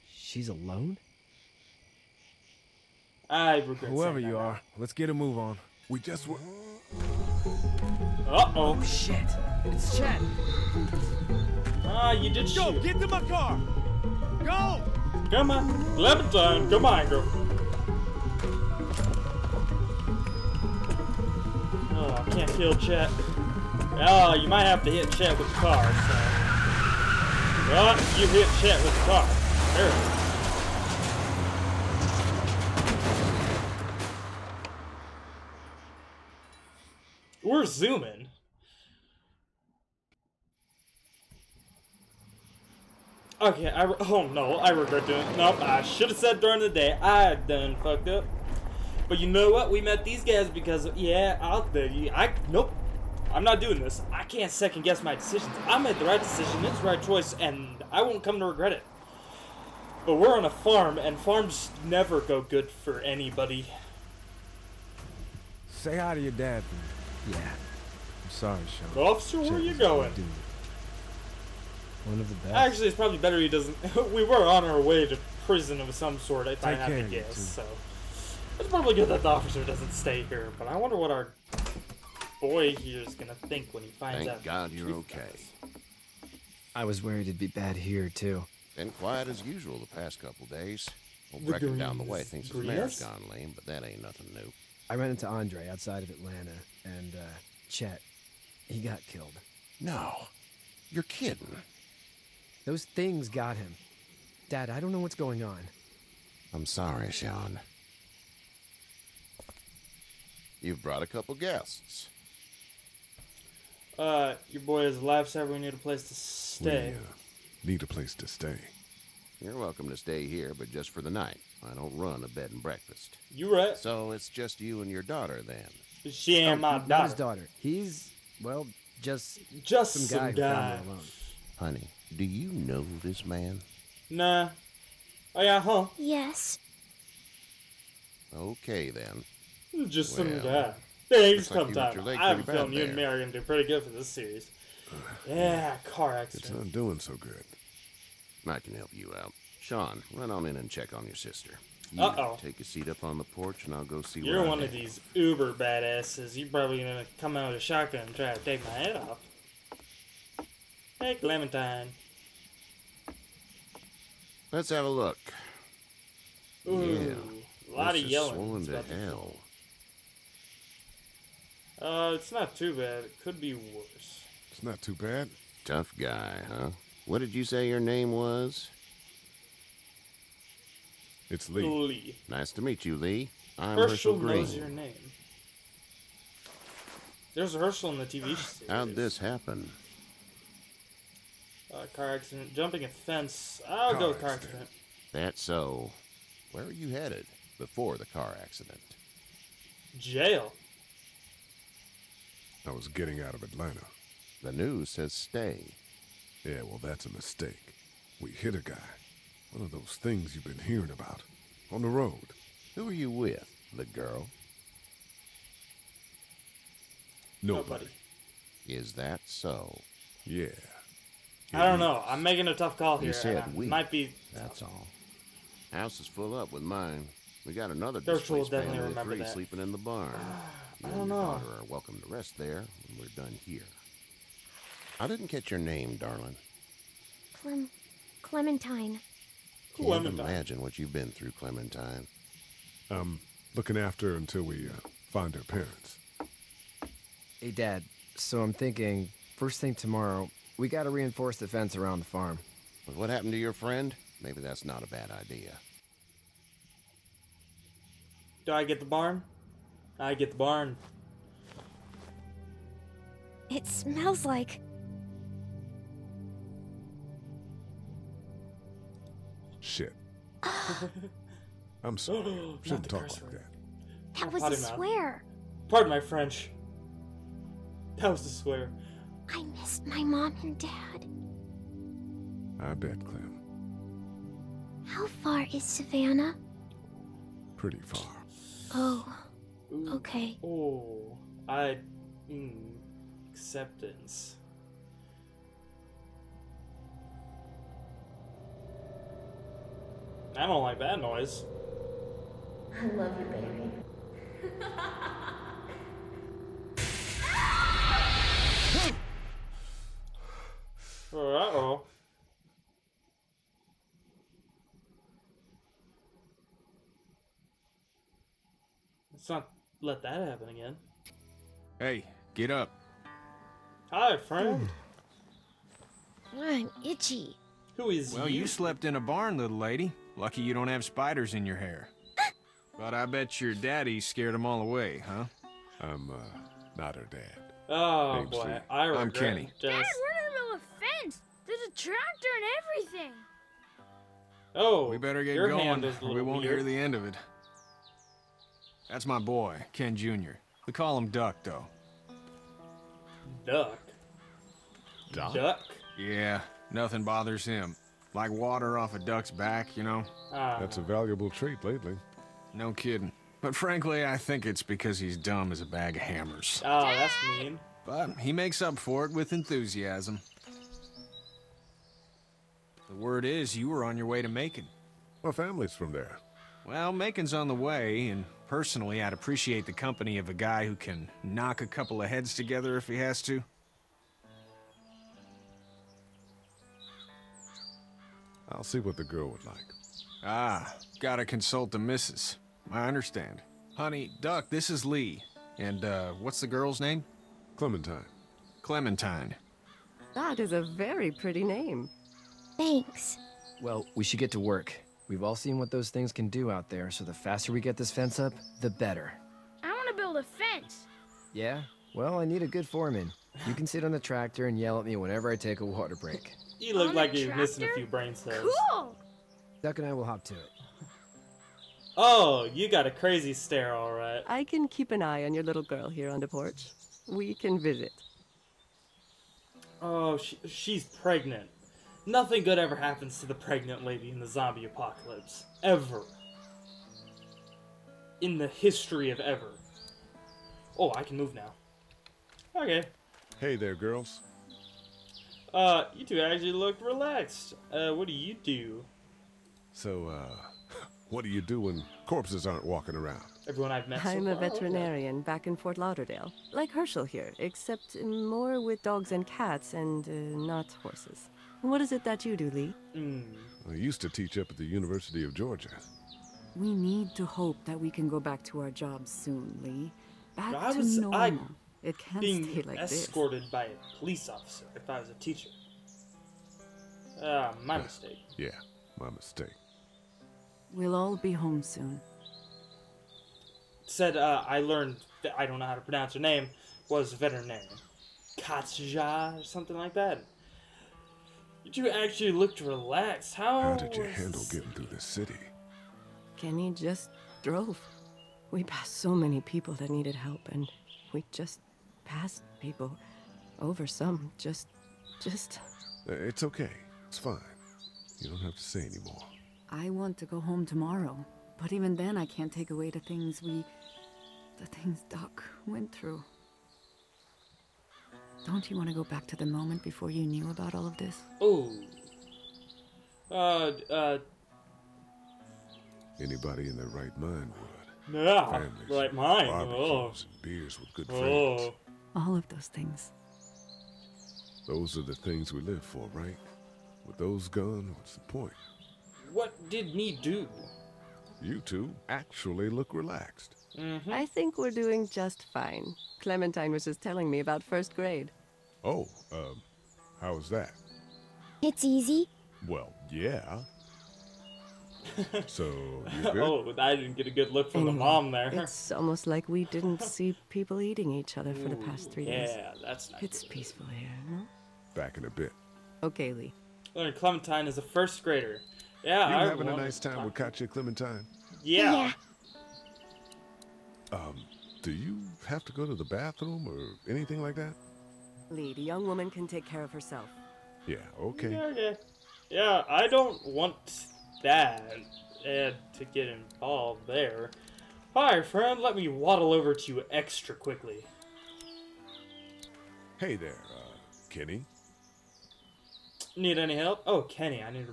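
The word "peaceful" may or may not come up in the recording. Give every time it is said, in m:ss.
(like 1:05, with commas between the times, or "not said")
9:23.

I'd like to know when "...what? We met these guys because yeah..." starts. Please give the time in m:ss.
0:49.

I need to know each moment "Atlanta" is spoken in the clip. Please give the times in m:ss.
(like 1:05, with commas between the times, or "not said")
1:36, 3:23.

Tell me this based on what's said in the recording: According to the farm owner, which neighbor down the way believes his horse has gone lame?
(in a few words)
Brecken.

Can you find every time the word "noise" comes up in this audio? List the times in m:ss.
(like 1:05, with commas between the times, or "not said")
5:00.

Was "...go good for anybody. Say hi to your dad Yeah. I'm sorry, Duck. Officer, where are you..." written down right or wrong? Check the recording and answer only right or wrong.
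wrong.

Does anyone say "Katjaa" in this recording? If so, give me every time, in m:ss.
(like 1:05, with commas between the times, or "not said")
8:08, 9:30.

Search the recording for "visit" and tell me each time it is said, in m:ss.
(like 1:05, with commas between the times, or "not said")
7:07.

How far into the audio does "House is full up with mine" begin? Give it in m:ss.
3:45.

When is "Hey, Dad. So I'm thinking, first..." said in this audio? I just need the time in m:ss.
4:07.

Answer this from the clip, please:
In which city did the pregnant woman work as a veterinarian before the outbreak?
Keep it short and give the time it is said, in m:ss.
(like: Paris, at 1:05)
Fort Lauderdale, at 7:35.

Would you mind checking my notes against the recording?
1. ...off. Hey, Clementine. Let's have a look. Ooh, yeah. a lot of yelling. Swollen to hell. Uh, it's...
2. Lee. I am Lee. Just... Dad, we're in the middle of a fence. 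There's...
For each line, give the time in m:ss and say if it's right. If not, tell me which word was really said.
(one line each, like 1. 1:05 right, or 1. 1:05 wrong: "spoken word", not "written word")
1. 2:38 right
2. 5:38 wrong: "Kenny", not "Lee".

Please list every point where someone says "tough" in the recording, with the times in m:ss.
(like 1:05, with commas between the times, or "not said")
2:55, 3:42.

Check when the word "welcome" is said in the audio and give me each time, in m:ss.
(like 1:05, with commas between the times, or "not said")
1:59, 3:51.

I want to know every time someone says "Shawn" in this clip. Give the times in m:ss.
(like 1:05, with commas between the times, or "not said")
1:08, 1:47, 2:29.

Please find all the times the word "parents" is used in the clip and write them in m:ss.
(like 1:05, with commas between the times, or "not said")
4:05.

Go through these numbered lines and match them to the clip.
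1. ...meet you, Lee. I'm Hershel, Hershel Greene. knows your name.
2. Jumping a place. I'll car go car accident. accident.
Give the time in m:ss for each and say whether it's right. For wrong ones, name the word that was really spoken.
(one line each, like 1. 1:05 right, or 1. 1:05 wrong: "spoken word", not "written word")
1. 3:02 right
2. 3:12 wrong: "fence", not "place".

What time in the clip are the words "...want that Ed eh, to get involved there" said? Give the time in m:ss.
9:43.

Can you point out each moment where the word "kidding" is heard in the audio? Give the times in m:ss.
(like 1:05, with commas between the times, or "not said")
1:41, 6:02.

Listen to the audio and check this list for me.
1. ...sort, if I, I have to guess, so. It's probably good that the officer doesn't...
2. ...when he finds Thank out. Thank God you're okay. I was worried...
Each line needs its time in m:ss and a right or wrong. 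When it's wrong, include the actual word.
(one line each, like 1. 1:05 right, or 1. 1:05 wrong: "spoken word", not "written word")
1. 1:16 right
2. 1:23 right.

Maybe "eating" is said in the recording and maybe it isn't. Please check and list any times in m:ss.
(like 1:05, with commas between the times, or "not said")
9:20.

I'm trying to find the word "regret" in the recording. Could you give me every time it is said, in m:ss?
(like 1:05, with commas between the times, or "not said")
0:03, 0:44, 0:58.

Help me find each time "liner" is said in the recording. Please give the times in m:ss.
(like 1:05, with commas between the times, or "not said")
not said.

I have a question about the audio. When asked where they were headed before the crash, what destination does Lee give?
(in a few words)
Jail.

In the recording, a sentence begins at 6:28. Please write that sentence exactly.
I'll see what the girl would like.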